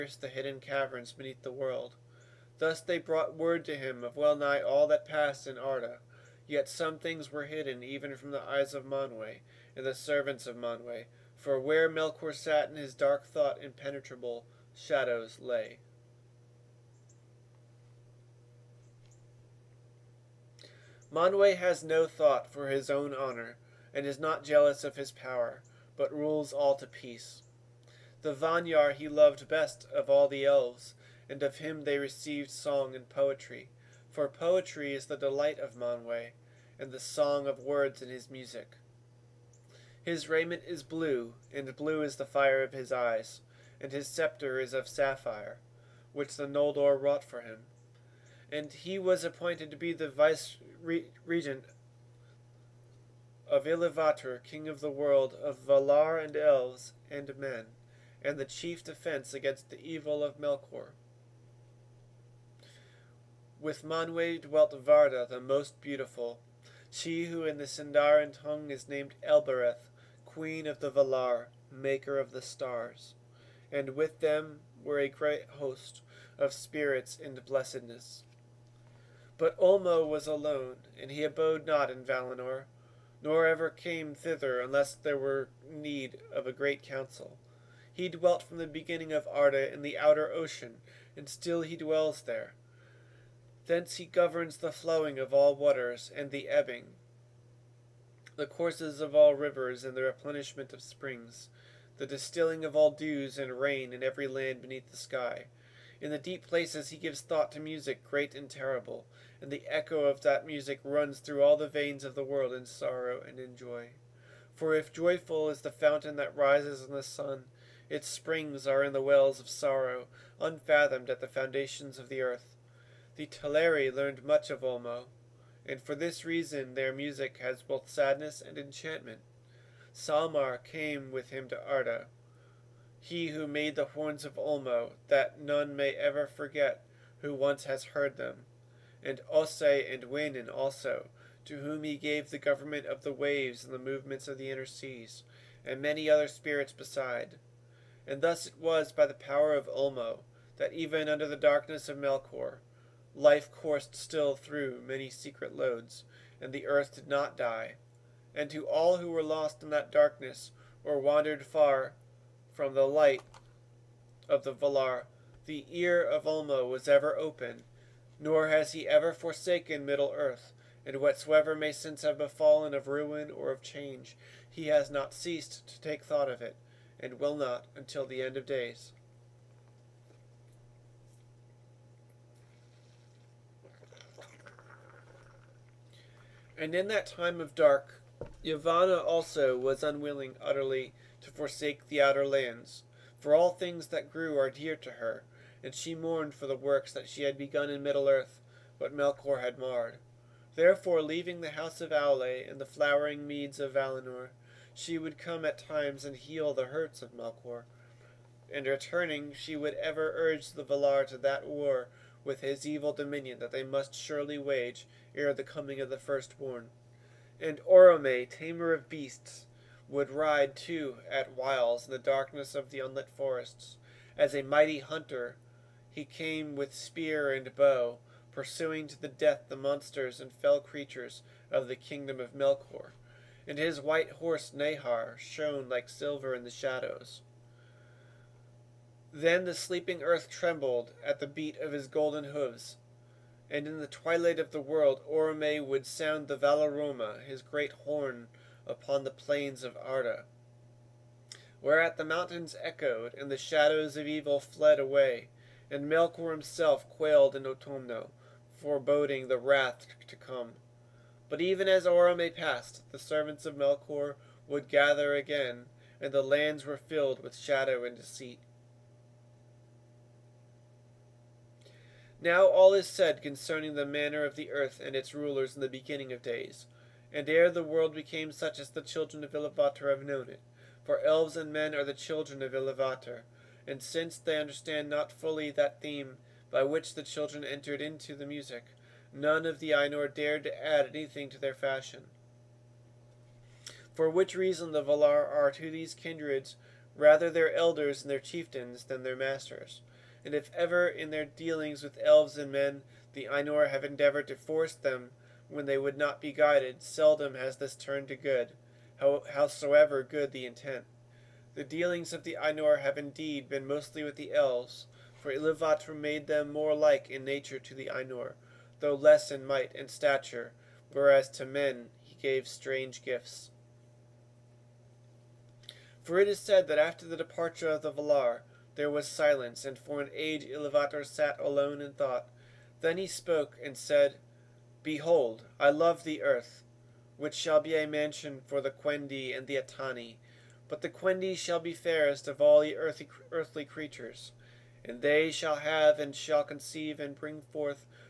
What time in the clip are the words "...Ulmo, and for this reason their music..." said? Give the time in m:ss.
2:04.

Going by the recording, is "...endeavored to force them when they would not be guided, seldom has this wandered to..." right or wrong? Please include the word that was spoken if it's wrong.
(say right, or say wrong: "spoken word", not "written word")
wrong: "turned", not "wandered".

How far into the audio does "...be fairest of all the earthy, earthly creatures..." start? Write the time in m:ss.
5:41.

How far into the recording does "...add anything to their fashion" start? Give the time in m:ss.
4:50.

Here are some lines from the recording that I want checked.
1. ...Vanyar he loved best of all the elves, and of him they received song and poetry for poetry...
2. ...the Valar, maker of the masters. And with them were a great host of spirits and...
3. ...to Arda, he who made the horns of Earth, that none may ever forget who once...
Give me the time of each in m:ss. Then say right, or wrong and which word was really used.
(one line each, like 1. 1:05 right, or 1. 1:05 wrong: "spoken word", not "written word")
1. 0:28 right
2. 1:10 wrong: "stars", not "masters"
3. 2:11 wrong: "Ulmo", not "Earth".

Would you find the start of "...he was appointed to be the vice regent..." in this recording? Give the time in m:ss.
0:48.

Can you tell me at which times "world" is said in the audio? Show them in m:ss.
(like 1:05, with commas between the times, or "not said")
0:01, 0:54, 1:52, 4:04, 4:37.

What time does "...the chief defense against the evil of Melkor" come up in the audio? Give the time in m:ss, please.
0:58.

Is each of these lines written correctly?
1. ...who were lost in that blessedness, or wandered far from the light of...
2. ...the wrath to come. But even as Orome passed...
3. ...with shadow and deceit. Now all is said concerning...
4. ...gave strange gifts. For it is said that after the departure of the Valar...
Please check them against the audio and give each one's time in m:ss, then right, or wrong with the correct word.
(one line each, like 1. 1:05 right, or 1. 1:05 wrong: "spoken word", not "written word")
1. 2:38 wrong: "darkness", not "blessedness"
2. 4:19 right
3. 4:27 right
4. 5:22 right.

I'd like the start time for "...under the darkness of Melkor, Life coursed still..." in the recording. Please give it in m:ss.
2:31.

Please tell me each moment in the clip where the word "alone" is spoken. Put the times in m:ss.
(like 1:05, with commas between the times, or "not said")
1:20, 5:31.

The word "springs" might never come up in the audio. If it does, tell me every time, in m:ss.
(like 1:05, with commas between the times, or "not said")
1:40, 1:58.